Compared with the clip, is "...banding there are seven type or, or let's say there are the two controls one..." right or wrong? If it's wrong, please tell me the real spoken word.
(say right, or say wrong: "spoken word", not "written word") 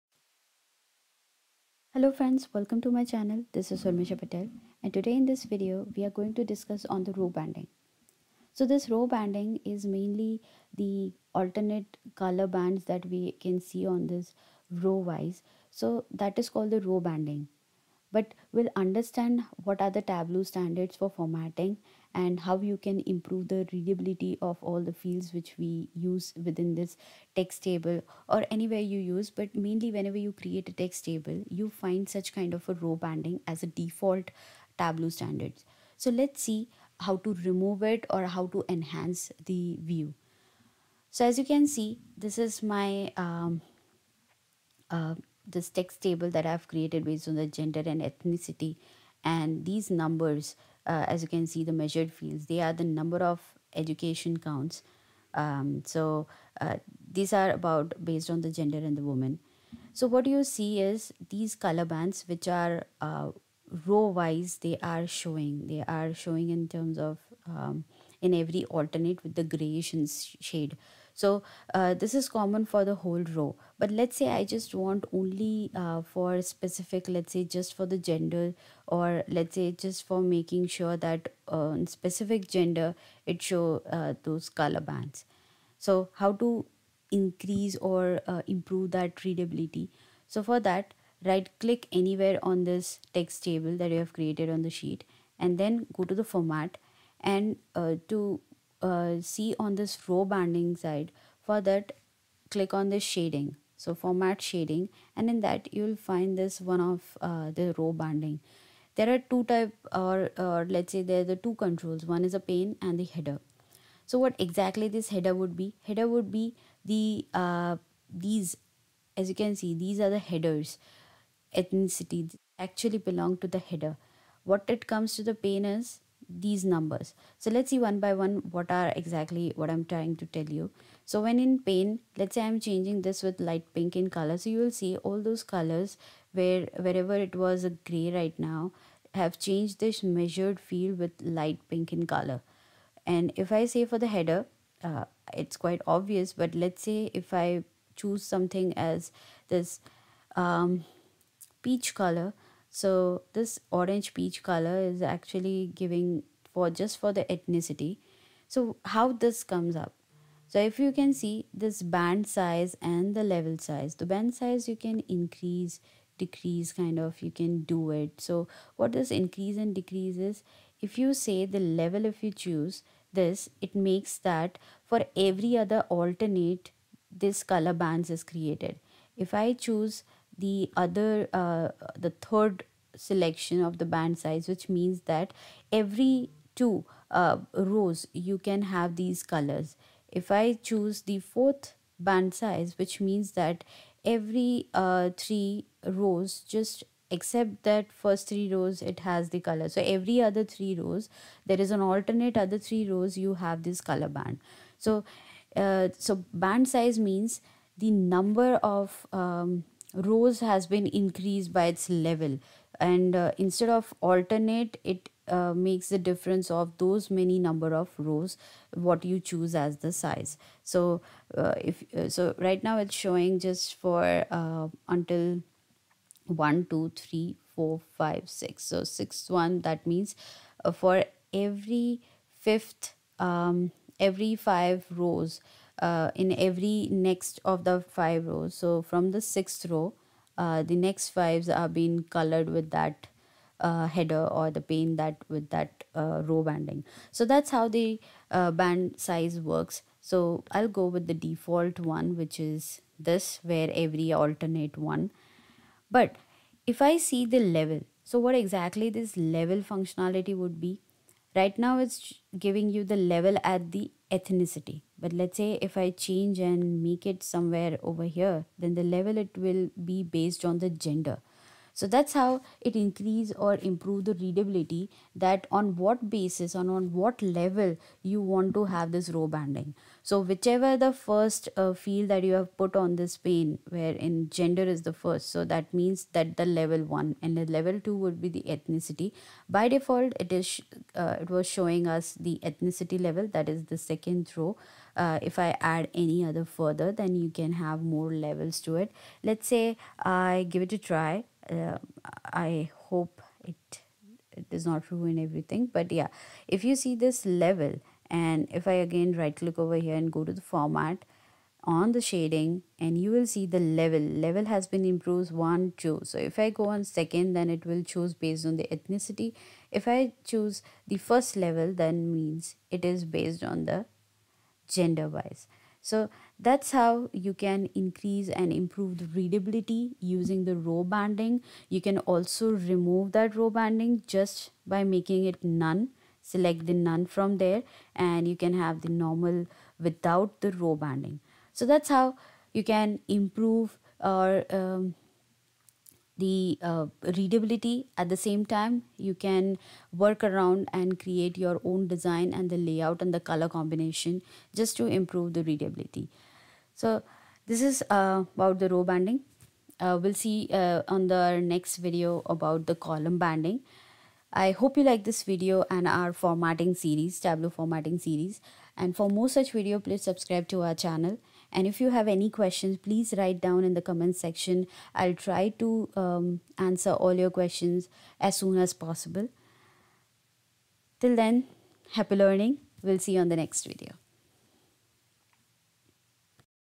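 wrong: "two", not "seven".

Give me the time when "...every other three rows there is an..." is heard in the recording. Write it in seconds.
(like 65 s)
199 s.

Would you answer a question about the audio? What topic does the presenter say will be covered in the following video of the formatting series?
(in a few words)
column banding.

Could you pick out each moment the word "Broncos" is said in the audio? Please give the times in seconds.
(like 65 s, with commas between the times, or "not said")
not said.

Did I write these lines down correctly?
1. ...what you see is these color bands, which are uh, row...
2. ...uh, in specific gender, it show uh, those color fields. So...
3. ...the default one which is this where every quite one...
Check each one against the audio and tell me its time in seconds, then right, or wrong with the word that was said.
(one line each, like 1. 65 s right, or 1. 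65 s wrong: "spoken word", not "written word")
1. 60 s right
2. 81 s wrong: "bands", not "fields"
3. 251 s wrong: "alternate", not "quite".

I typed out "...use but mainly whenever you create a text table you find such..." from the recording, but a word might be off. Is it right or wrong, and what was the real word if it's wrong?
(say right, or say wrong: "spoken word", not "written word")
right.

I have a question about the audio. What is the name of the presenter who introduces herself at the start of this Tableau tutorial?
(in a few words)
Urmisha Patel.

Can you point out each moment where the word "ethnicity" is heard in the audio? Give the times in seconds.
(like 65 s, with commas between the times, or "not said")
48 s, 121 s, 157 s, 264 s, 288 s, 292 s, 318 s.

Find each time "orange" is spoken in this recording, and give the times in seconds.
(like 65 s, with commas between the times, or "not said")
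153 s.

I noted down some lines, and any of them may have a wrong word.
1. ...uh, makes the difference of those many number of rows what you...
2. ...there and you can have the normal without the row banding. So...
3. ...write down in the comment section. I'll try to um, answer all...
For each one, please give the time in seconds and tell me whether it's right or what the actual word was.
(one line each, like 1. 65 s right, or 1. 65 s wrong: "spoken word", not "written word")
1. 215 s right
2. 337 s right
3. 373 s right.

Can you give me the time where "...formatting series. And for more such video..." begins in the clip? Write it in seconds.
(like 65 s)
367 s.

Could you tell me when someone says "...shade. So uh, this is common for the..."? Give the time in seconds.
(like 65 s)
70 s.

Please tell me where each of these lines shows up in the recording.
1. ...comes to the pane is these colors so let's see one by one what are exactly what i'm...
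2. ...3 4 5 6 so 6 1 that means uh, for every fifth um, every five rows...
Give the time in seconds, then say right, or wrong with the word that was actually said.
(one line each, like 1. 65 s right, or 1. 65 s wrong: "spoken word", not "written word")
1. 124 s wrong: "numbers", not "colors"
2. 226 s right.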